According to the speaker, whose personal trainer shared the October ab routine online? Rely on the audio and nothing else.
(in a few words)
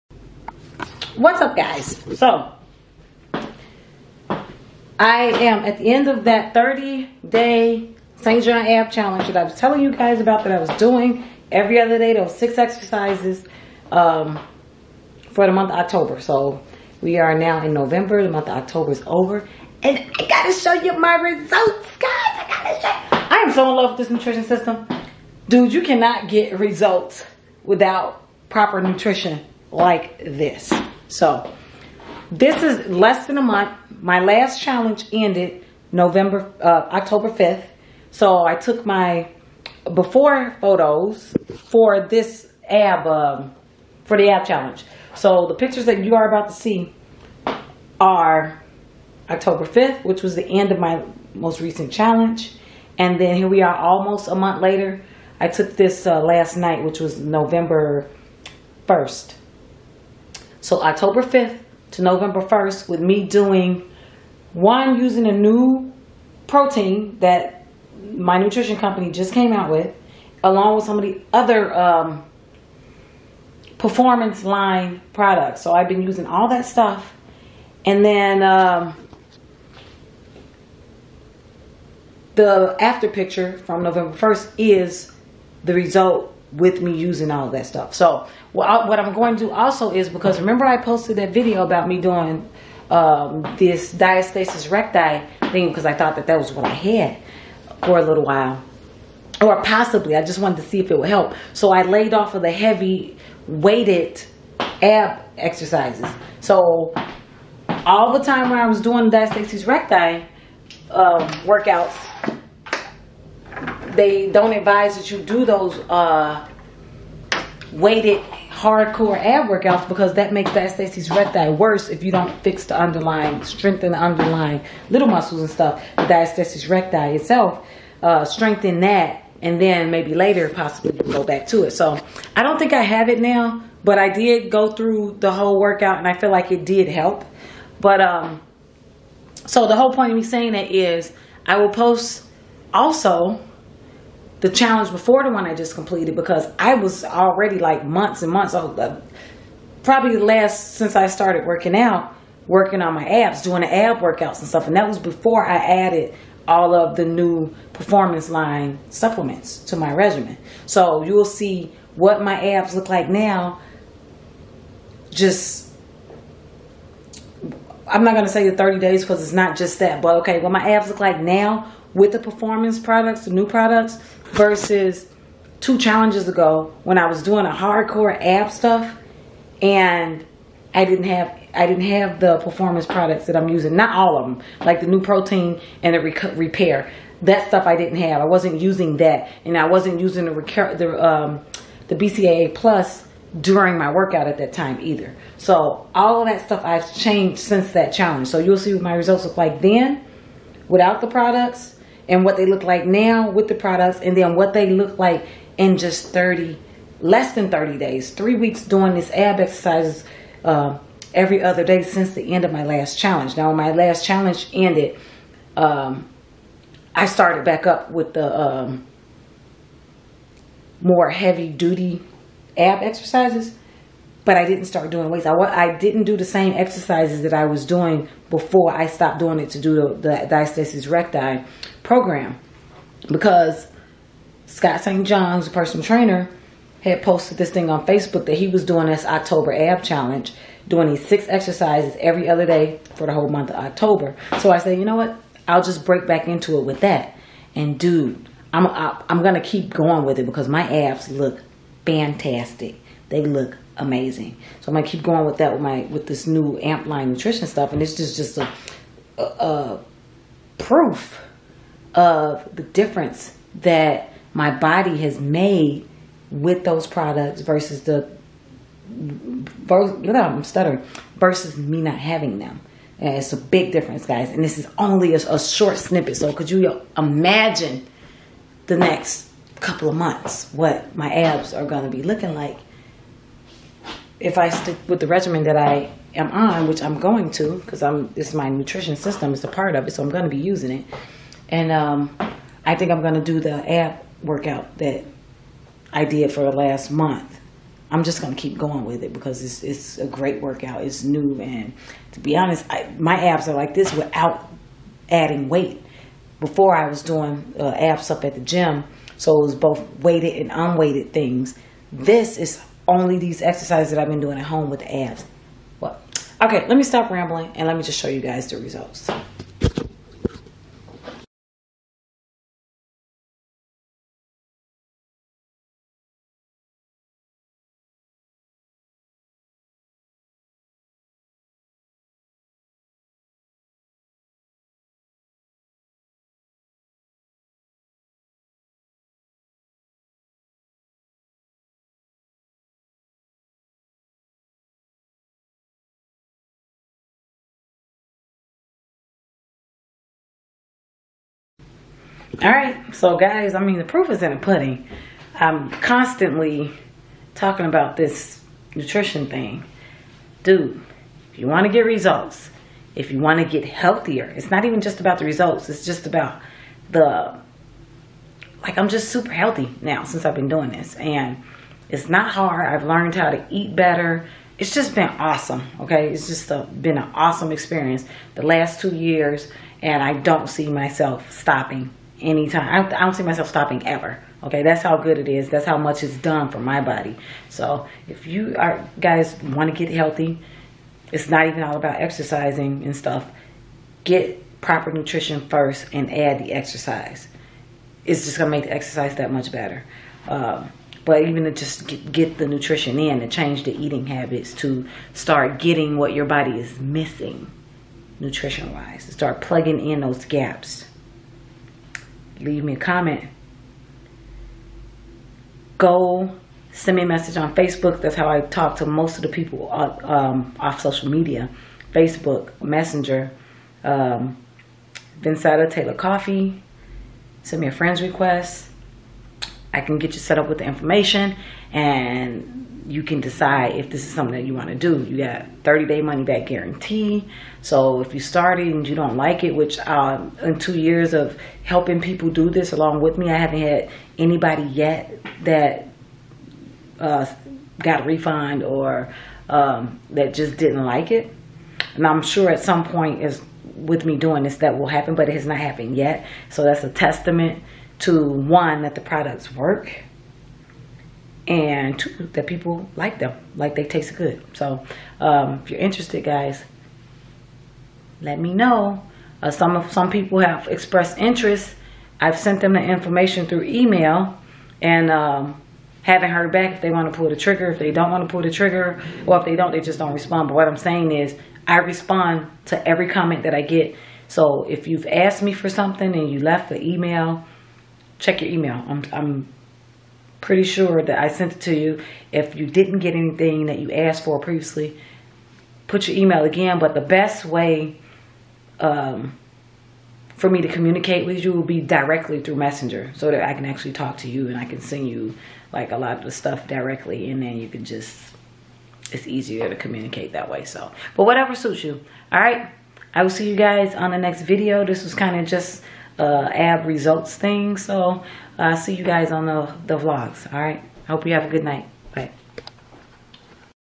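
Scott St. John.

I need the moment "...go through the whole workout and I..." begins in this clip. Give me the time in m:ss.
2:14.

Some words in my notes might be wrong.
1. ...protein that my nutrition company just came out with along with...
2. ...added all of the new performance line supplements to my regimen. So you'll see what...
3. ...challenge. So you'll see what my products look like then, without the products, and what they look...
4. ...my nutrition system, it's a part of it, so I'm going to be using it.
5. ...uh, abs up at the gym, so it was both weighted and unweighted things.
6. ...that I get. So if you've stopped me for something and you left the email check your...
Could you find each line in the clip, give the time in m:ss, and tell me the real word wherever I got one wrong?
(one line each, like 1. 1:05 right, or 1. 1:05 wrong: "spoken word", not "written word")
1. 1:06 right
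2. 2:35 right
3. 3:17 wrong: "results", not "products"
4. 4:48 right
5. 5:07 right
6. 8:03 wrong: "asked", not "stopped".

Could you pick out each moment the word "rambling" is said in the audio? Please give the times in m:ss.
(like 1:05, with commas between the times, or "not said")
5:17.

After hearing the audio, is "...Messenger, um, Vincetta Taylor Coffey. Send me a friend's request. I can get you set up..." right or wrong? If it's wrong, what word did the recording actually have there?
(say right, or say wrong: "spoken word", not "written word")
right.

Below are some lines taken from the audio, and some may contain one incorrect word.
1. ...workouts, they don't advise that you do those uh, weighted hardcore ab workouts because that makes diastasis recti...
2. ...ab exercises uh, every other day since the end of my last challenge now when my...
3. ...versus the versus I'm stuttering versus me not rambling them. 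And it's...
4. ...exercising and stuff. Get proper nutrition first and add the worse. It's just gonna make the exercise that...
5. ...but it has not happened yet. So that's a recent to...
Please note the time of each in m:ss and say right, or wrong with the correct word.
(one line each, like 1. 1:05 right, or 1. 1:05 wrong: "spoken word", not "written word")
1. 1:51 right
2. 3:29 right
3. 4:27 wrong: "having", not "rambling"
4. 6:32 wrong: "exercise", not "worse"
5. 7:35 wrong: "testament", not "recent".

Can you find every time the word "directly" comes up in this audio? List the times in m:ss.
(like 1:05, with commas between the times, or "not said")
8:21, 8:26.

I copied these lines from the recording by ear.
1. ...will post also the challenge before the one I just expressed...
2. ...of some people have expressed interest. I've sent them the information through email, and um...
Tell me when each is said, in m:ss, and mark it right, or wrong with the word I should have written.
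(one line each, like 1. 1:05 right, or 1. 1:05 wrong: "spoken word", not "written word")
1. 2:21 wrong: "completed", not "expressed"
2. 7:49 right.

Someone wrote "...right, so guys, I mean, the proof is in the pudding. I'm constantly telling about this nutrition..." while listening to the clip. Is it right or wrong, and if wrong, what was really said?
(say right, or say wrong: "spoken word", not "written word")
wrong: "talking", not "telling".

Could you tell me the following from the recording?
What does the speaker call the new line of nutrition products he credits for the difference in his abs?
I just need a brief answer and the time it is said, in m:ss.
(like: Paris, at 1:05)
amp line, at 4:16.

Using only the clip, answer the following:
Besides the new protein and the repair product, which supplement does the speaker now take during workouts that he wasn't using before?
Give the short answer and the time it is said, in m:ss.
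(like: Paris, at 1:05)
BCAA plus, at 3:11.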